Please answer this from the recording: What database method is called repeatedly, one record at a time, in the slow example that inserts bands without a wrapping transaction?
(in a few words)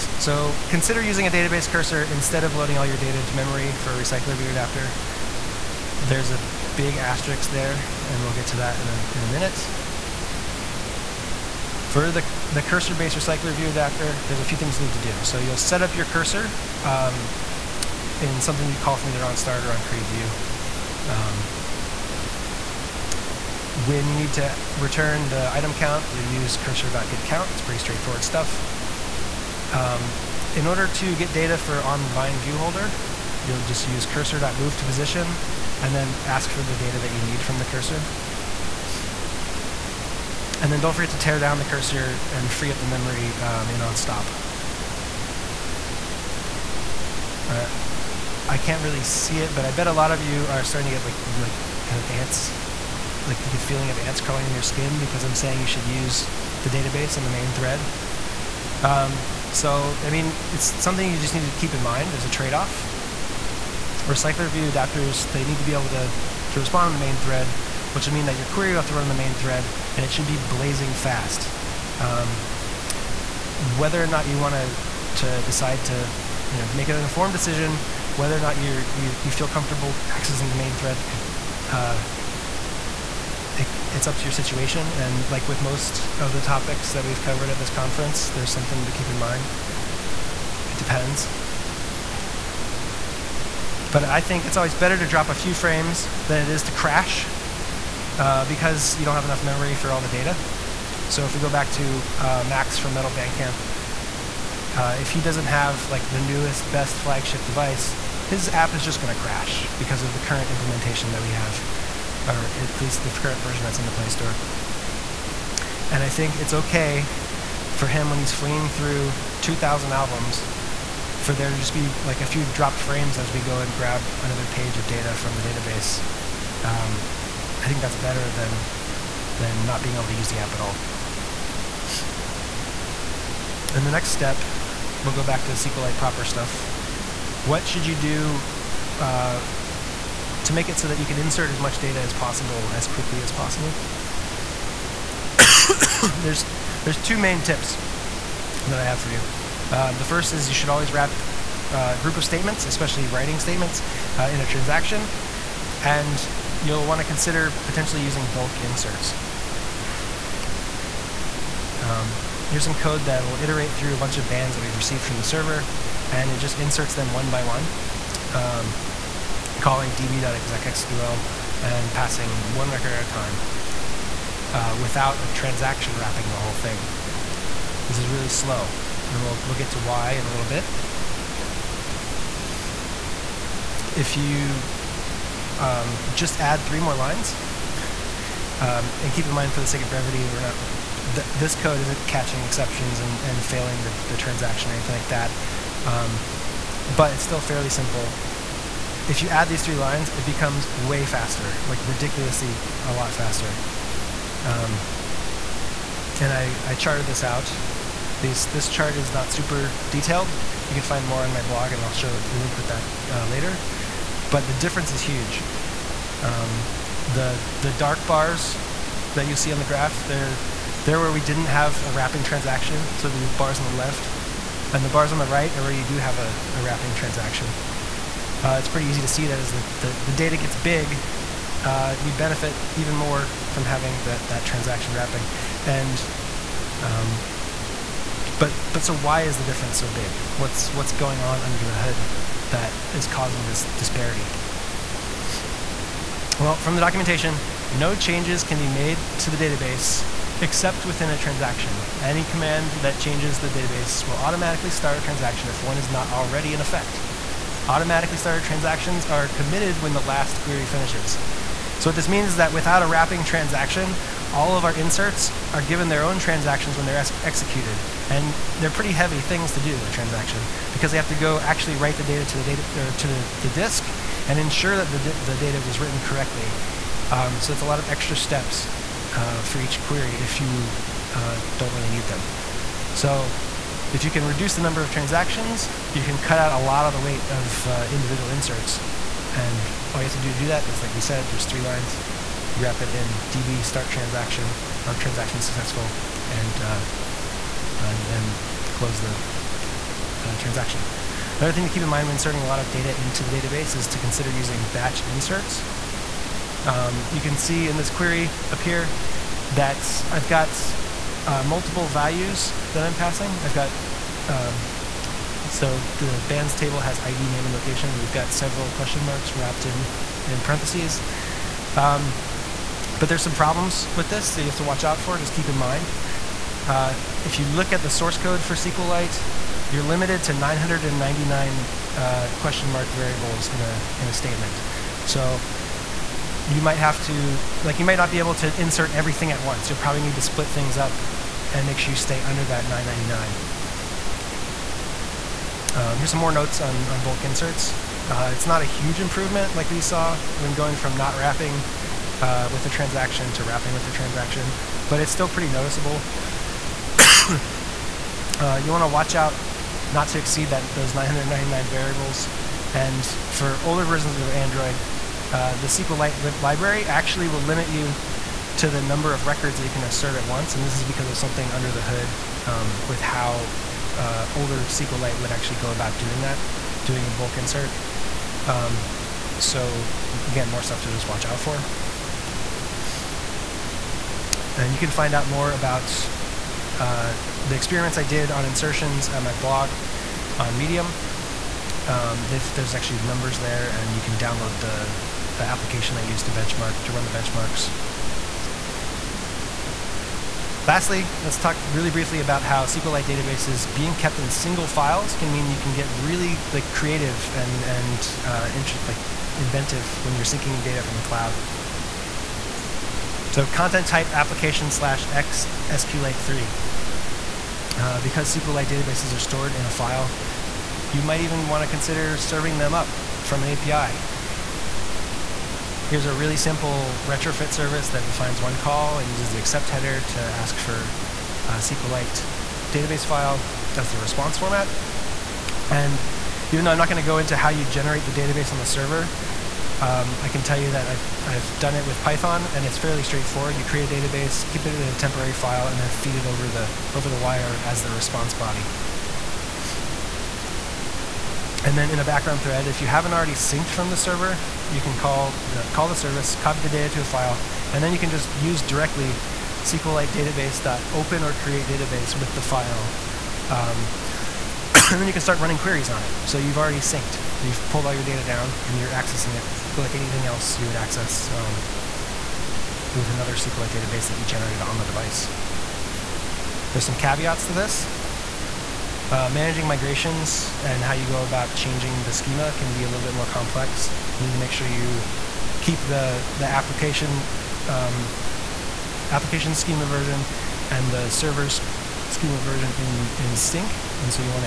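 db.execSQL.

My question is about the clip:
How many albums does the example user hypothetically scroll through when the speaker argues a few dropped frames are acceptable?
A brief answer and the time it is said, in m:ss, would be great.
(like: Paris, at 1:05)
2,000, at 1:59.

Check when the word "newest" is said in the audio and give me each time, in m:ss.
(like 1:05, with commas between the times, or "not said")
1:46.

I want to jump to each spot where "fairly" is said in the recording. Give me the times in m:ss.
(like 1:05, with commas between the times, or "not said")
3:17, 7:22.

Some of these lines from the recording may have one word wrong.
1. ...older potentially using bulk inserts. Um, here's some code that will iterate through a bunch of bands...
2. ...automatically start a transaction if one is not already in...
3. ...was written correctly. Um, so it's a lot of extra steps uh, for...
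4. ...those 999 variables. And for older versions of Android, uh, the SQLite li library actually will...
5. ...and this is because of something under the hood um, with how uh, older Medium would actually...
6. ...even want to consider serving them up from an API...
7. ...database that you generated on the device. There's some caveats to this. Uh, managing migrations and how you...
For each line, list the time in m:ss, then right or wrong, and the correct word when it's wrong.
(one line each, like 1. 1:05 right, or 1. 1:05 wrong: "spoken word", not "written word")
1. 2:37 wrong: "consider", not "older"
2. 4:14 right
3. 4:35 right
4. 6:00 right
5. 6:10 wrong: "SQLite", not "Medium"
6. 7:01 right
7. 7:53 right.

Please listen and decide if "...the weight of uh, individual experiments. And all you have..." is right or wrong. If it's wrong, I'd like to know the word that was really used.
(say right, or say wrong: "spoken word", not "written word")
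wrong: "inserts", not "experiments".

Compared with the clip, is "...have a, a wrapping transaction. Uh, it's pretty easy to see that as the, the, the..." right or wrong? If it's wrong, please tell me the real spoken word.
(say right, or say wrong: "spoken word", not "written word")
right.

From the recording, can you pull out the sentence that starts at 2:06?
Um, I think that's better than, than not being able to use the app at all.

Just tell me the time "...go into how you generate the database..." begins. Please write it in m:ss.
7:17.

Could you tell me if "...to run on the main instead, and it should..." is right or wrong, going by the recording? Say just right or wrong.
wrong.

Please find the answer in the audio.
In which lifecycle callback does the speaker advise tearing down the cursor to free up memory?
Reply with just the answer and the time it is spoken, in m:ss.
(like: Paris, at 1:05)
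onStop, at 0:43.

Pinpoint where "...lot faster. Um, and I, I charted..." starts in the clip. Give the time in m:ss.
3:22.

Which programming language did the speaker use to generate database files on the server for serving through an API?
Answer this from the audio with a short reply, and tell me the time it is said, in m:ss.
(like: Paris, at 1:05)
Python, at 7:22.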